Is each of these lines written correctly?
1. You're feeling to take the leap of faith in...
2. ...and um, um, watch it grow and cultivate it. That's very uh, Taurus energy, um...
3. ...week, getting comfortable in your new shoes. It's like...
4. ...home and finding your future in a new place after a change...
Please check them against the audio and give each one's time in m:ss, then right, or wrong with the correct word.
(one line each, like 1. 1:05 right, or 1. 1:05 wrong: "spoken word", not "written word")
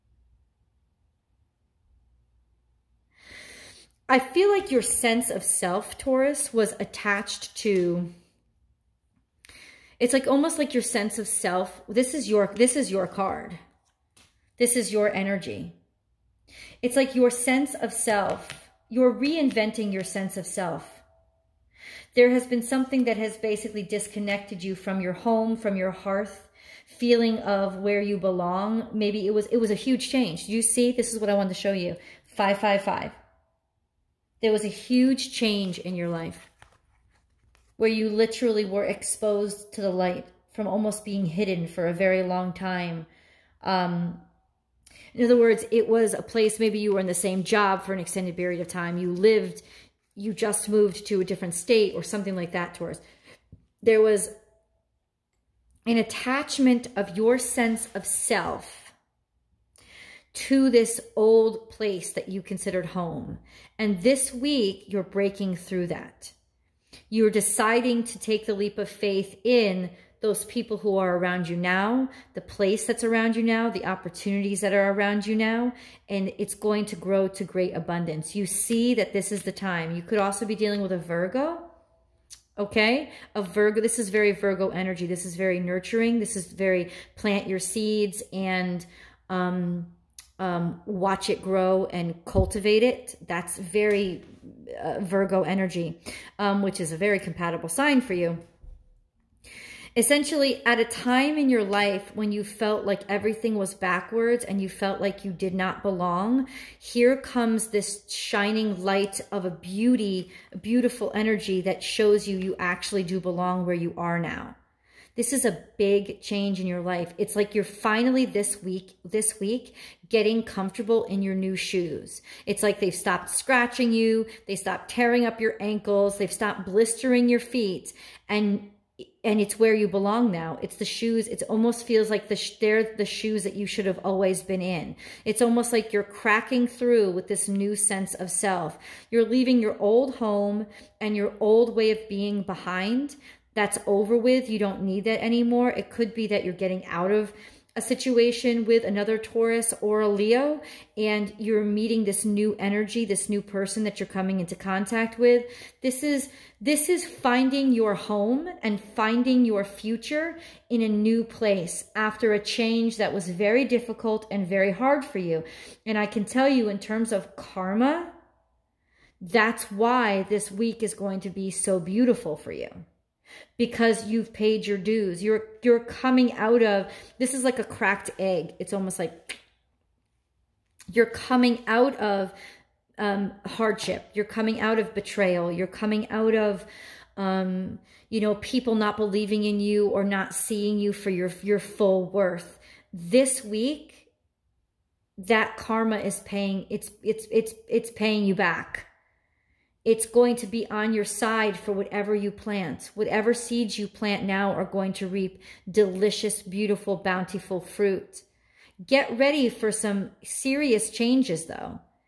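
1. 1:07 wrong: "deciding", not "feeling"
2. 1:28 wrong: "Virgo", not "Taurus"
3. 1:59 right
4. 2:37 right.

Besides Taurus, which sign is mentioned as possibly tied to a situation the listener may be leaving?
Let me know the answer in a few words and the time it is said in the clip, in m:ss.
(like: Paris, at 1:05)
Leo, at 2:30.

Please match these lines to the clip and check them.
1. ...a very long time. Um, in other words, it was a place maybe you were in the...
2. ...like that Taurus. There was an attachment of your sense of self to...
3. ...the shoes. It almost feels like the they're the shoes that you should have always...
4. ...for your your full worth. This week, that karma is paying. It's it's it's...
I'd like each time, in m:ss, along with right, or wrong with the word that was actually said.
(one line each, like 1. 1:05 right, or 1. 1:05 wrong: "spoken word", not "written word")
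1. 0:41 right
2. 0:52 right
3. 2:10 right
4. 3:10 right.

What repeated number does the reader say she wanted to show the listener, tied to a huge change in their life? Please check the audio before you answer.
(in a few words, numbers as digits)
555.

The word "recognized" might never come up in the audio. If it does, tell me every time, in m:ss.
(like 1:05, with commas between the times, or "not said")
not said.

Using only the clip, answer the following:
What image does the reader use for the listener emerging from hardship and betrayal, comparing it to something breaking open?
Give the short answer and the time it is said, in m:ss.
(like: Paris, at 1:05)
A cracked egg, at 2:57.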